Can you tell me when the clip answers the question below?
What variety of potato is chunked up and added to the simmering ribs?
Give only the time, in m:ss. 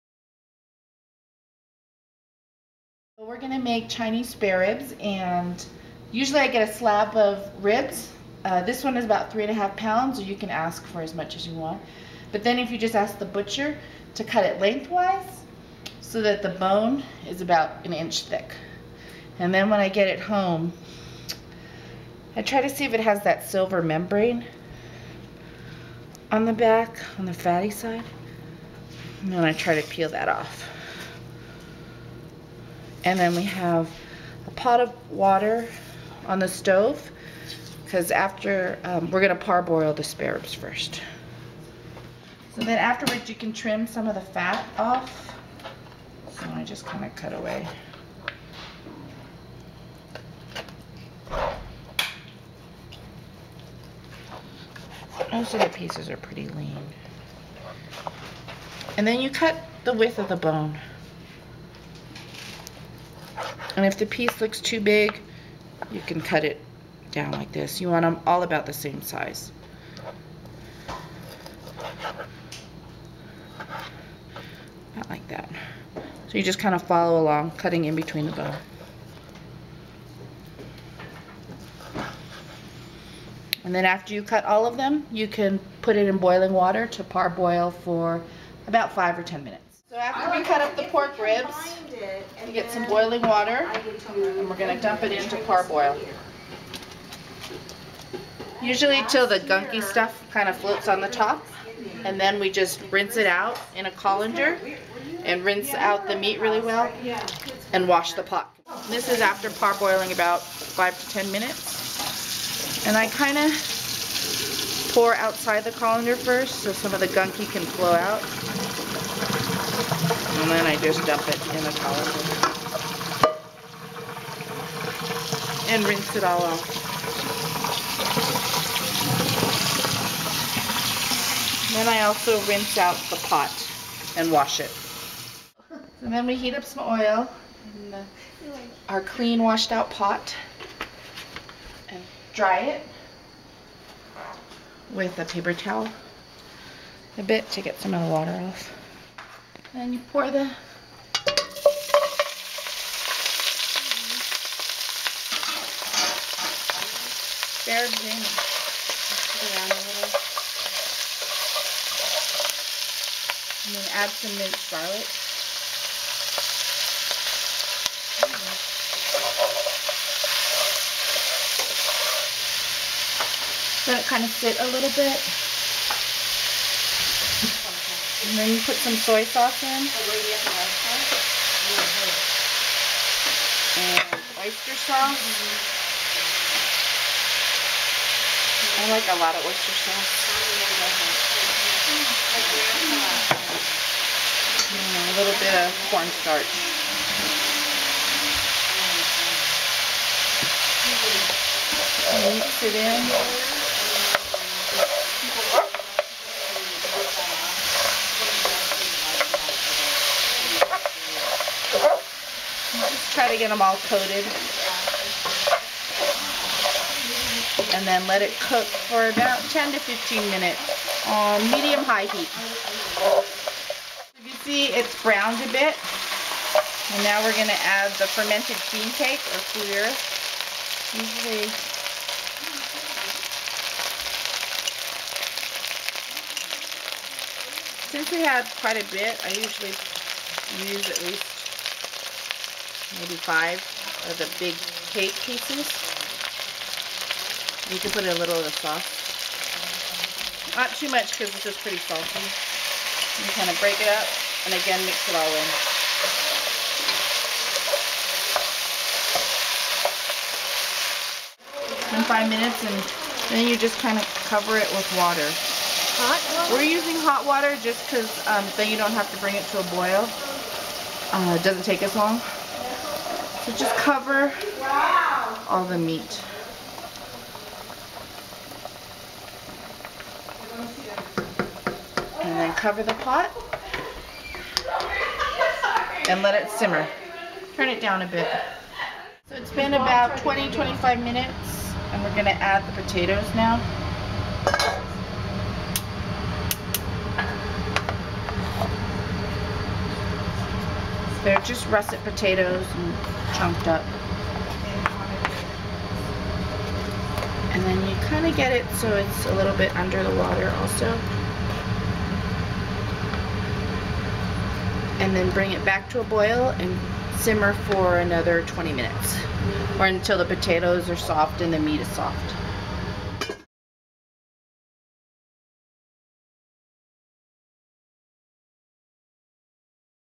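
5:01.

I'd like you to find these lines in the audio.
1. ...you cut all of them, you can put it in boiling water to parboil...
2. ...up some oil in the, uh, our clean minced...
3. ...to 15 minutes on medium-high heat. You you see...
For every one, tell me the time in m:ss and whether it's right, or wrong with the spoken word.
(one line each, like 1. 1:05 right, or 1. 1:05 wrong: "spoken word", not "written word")
1. 1:24 right
2. 2:16 wrong: "washed", not "minced"
3. 3:39 right.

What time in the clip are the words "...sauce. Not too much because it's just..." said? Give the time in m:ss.
4:08.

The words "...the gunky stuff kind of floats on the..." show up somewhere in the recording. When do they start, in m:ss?
1:39.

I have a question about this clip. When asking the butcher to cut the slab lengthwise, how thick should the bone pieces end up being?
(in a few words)
about an inch.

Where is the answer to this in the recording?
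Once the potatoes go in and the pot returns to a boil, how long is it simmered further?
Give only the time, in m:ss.
5:17.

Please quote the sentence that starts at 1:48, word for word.
This is after parboiling about 5 to 10 minutes.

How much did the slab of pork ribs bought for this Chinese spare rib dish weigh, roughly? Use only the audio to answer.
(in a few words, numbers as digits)
3.5 pounds.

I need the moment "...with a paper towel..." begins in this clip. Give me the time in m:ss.
2:24.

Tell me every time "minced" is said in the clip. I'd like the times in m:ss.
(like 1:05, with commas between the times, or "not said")
2:44.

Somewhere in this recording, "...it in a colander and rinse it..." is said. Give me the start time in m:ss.
2:01.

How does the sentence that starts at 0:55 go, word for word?
Most of the pieces are pretty lean.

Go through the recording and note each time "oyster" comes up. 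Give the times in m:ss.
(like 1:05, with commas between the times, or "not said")
3:04, 3:09.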